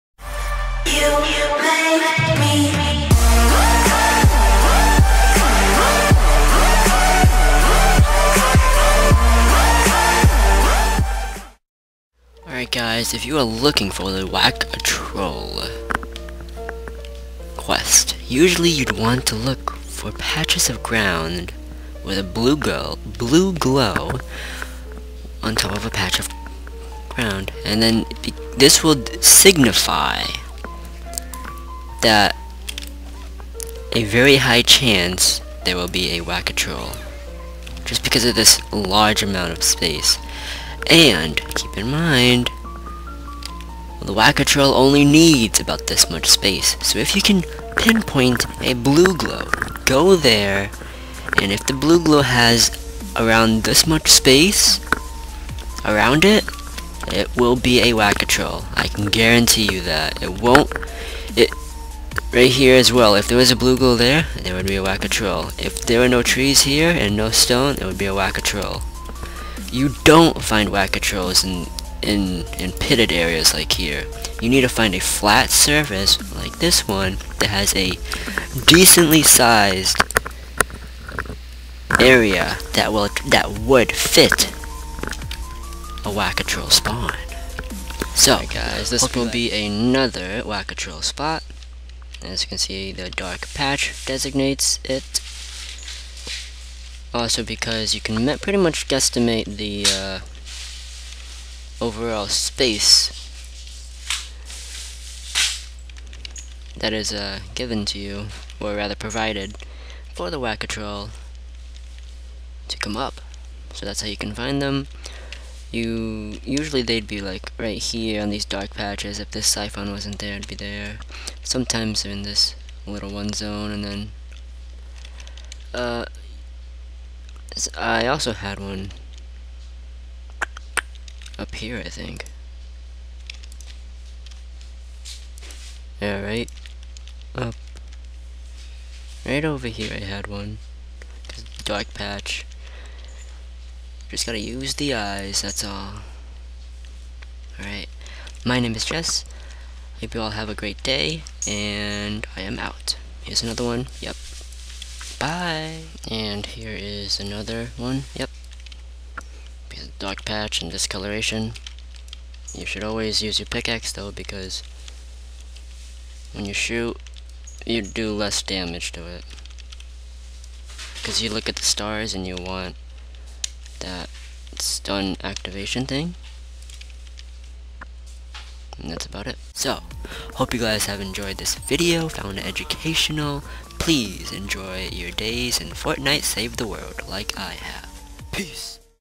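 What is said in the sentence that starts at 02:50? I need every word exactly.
Because you look at the stars and you want that stun activation thing.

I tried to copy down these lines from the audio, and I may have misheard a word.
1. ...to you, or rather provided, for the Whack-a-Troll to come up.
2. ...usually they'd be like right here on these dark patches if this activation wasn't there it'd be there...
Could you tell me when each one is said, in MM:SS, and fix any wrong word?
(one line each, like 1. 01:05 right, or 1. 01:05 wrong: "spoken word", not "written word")
1. 01:47 right
2. 01:56 wrong: "siphon", not "activation".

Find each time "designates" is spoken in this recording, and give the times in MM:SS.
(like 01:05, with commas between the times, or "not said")
01:34.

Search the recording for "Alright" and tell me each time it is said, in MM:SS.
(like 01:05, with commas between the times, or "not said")
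00:12, 02:27.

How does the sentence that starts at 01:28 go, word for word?
So, right, guys, this will be, be another Whack-a-Troll spot.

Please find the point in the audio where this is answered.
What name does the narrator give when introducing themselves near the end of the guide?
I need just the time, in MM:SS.
02:28.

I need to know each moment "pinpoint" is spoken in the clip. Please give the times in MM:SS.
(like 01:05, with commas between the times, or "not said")
00:47.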